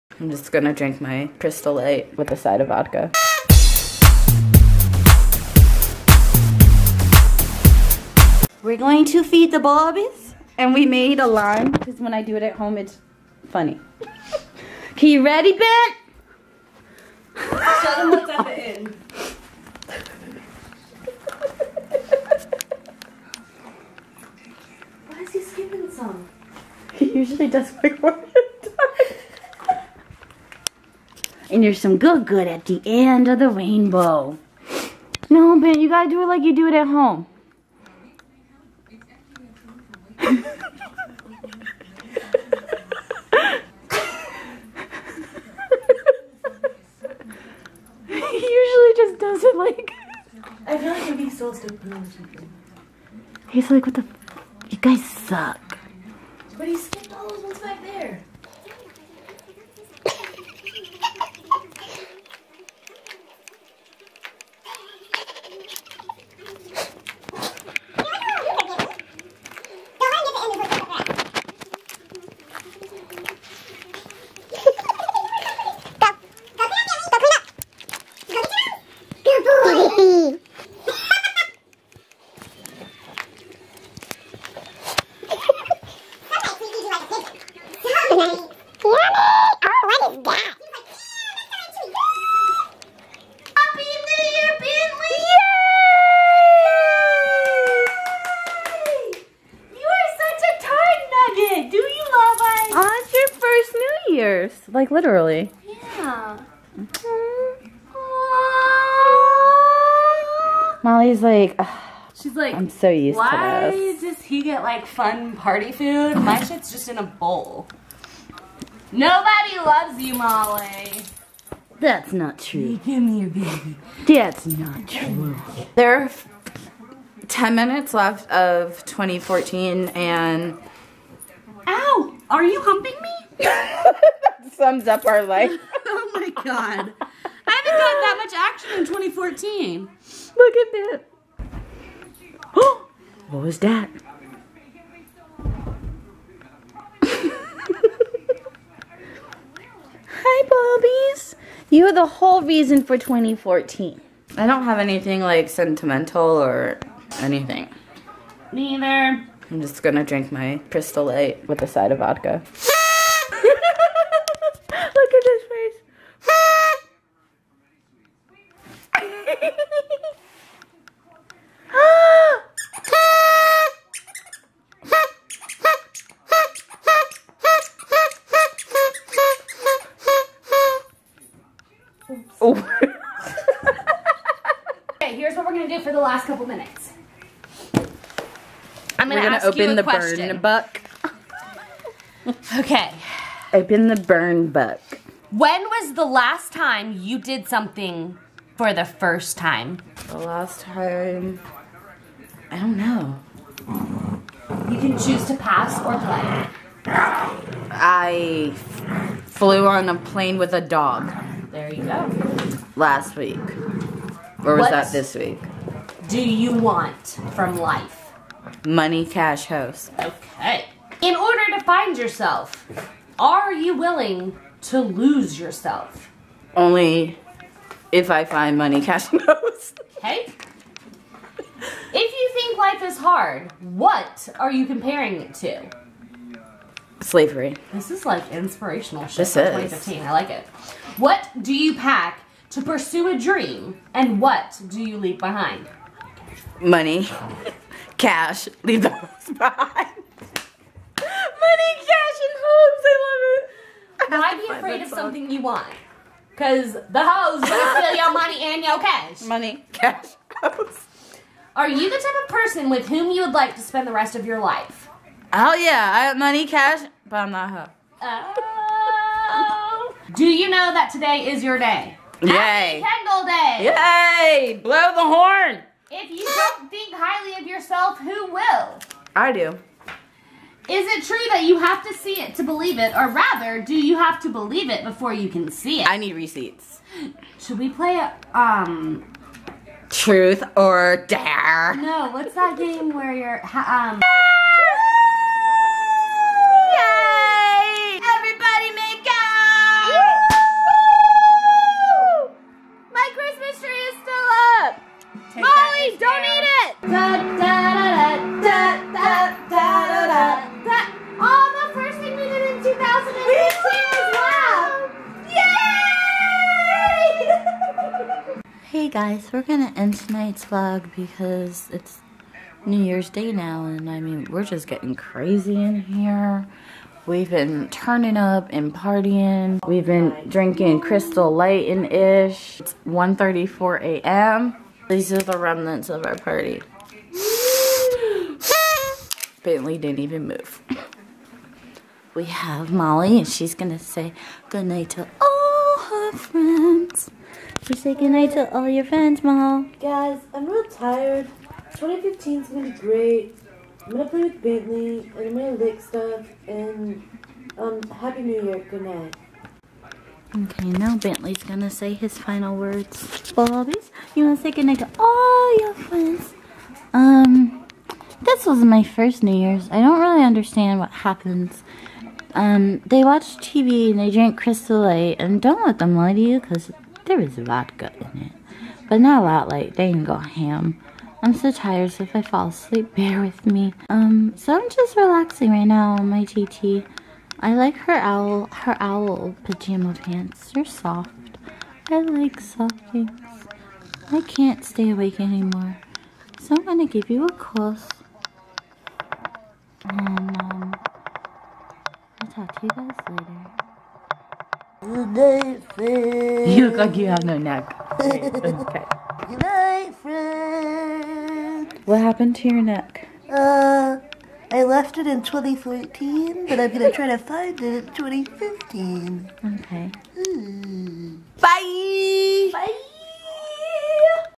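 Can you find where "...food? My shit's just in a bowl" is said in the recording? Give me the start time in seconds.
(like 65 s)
115 s.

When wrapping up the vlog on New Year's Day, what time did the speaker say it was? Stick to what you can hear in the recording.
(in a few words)
1:34 a.m.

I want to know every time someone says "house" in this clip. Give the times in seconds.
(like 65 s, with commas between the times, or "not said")
219 s, 229 s.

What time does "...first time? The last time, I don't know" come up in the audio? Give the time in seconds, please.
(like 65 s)
198 s.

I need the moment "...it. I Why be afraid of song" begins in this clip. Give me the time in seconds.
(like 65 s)
253 s.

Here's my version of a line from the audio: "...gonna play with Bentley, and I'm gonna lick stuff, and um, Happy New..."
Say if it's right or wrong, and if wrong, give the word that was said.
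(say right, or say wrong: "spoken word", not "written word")
right.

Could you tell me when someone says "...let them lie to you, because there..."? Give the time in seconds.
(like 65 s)
375 s.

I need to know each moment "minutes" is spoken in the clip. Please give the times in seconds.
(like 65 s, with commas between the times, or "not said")
127 s, 186 s.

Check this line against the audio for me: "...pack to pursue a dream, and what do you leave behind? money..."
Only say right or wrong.
right.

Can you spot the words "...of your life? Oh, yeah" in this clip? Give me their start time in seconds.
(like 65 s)
264 s.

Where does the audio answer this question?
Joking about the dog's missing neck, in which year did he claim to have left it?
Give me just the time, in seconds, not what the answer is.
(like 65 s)
415 s.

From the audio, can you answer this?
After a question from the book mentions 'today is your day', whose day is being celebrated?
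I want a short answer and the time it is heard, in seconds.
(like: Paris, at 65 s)
Kendall, at 272 s.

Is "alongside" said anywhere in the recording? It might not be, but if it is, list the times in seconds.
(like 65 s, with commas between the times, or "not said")
not said.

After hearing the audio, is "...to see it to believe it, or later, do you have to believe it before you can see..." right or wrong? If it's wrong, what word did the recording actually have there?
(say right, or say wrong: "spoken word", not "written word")
wrong: "rather", not "later".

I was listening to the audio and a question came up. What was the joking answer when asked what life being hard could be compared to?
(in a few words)
Slavery.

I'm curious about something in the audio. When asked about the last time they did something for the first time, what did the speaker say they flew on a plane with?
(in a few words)
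A dog.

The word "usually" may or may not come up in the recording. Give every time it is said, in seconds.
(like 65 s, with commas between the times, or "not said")
27 s, 48 s.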